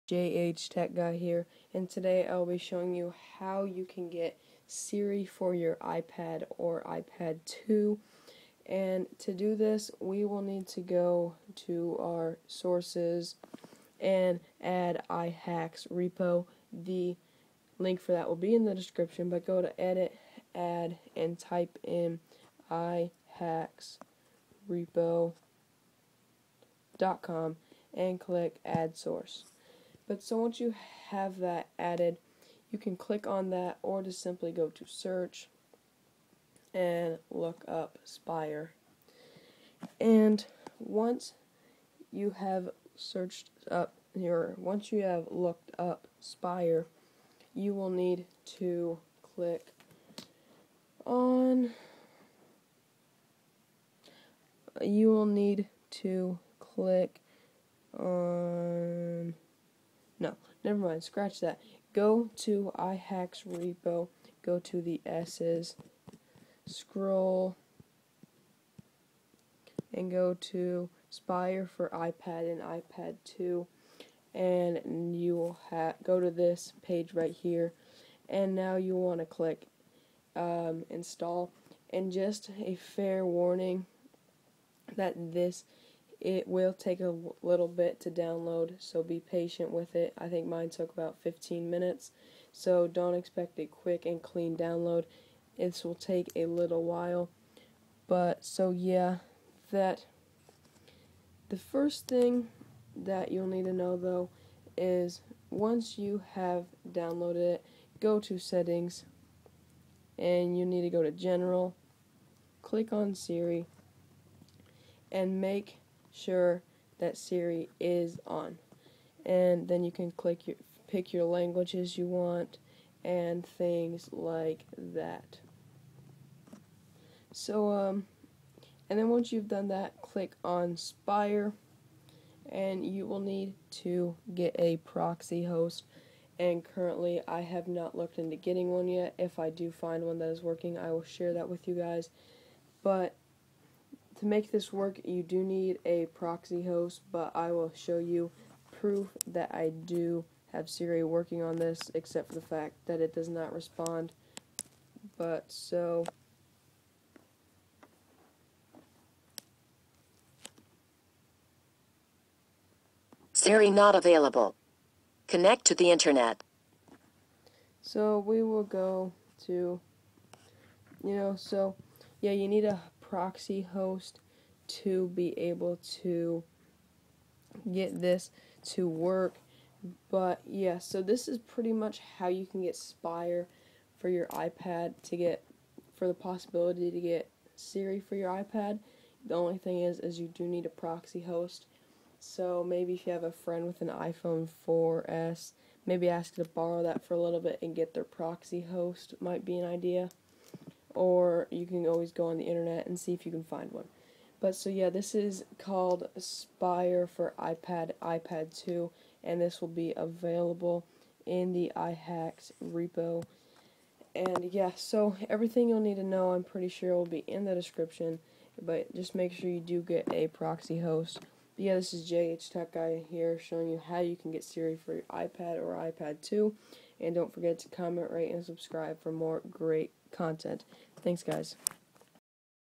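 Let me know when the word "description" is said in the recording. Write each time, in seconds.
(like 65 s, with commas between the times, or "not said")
18 s, 217 s.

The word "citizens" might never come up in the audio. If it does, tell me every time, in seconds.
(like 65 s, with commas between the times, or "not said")
not said.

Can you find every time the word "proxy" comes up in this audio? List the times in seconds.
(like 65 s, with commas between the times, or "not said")
134 s, 146 s, 173 s, 190 s, 198 s, 220 s.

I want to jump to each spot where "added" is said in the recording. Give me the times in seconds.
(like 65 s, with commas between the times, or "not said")
31 s.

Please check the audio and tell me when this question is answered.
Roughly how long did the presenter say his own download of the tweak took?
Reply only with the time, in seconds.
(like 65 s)
91 s.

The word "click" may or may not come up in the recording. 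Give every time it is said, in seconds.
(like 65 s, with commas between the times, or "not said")
28 s, 32 s, 49 s, 56 s, 79 s, 112 s, 120 s, 130 s.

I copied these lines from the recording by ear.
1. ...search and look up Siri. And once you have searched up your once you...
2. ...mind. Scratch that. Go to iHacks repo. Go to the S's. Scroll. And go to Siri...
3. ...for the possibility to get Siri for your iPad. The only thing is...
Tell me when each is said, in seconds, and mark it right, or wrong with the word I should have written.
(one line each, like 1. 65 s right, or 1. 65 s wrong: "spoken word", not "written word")
1. 34 s wrong: "Spire", not "Siri"
2. 60 s wrong: "Spire", not "Siri"
3. 185 s right.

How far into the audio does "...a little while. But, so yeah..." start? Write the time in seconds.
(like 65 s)
96 s.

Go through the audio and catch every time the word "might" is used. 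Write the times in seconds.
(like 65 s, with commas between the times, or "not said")
199 s.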